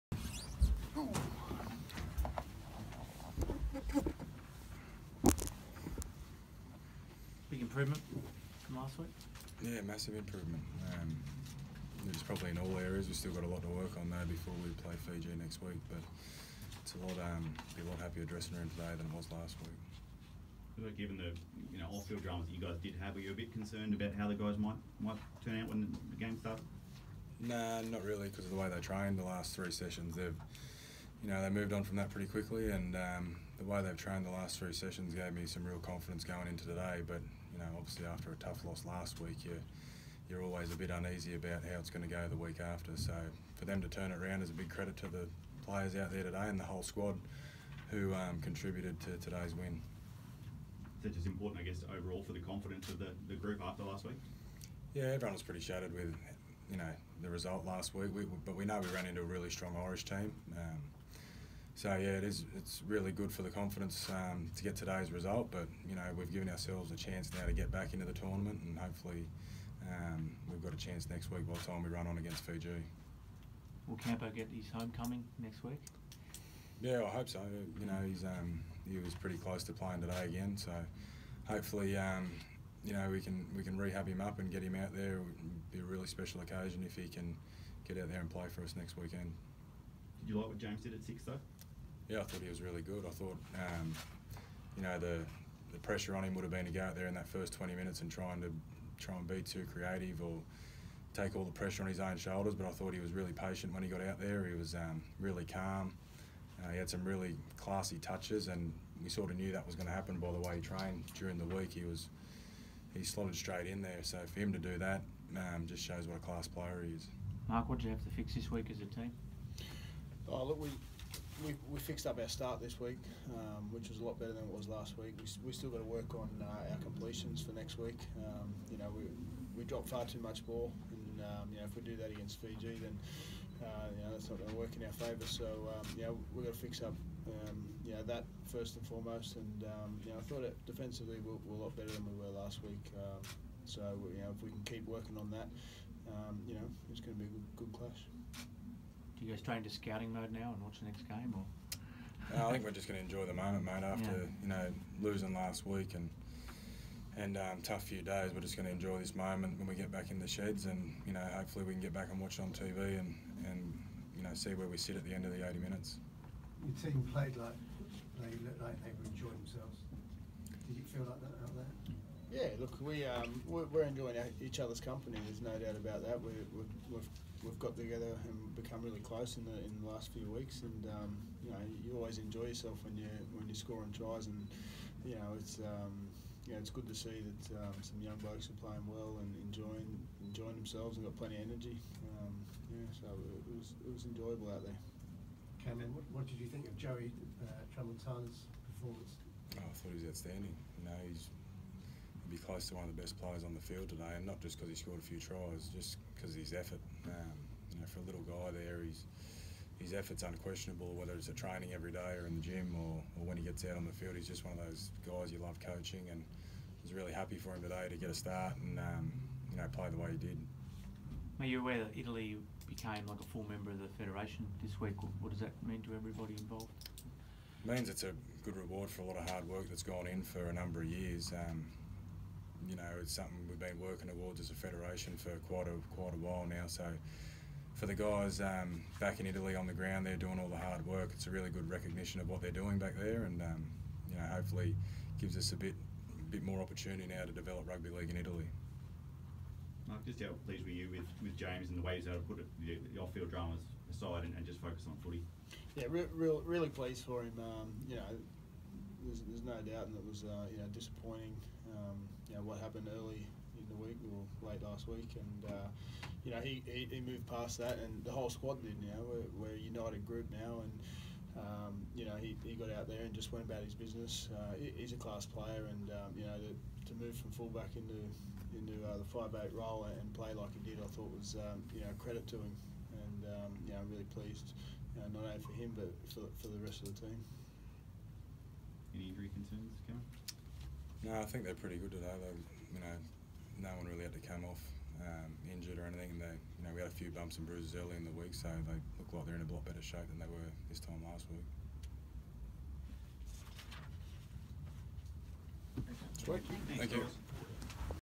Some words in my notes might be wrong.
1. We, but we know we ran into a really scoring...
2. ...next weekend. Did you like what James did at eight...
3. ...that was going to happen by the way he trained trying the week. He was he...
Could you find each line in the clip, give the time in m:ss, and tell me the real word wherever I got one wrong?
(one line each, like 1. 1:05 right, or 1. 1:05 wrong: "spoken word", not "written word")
1. 0:58 wrong: "strong", not "scoring"
2. 1:28 wrong: "six", not "eight"
3. 1:49 wrong: "during", not "trying".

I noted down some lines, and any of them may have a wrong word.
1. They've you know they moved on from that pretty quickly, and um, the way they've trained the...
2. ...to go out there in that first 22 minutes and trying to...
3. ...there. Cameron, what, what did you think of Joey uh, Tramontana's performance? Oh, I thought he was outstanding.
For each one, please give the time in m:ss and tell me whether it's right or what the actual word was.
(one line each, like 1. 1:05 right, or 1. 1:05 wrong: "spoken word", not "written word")
1. 0:30 right
2. 1:36 wrong: "20", not "22"
3. 3:14 right.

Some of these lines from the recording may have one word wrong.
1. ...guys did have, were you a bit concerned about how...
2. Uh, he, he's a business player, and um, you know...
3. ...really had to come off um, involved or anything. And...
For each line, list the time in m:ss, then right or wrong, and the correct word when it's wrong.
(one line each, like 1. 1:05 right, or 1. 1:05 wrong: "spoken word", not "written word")
1. 0:22 right
2. 4:34 wrong: "class", not "business"
3. 4:53 wrong: "injured", not "involved".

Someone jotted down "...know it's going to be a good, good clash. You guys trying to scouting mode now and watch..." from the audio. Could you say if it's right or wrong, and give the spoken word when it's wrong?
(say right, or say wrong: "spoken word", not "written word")
right.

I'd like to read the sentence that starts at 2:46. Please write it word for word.
Your team played like they looked like they were enjoying themselves.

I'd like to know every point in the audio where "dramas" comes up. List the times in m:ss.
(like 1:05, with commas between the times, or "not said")
0:22, 4:13.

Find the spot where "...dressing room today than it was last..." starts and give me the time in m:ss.
0:18.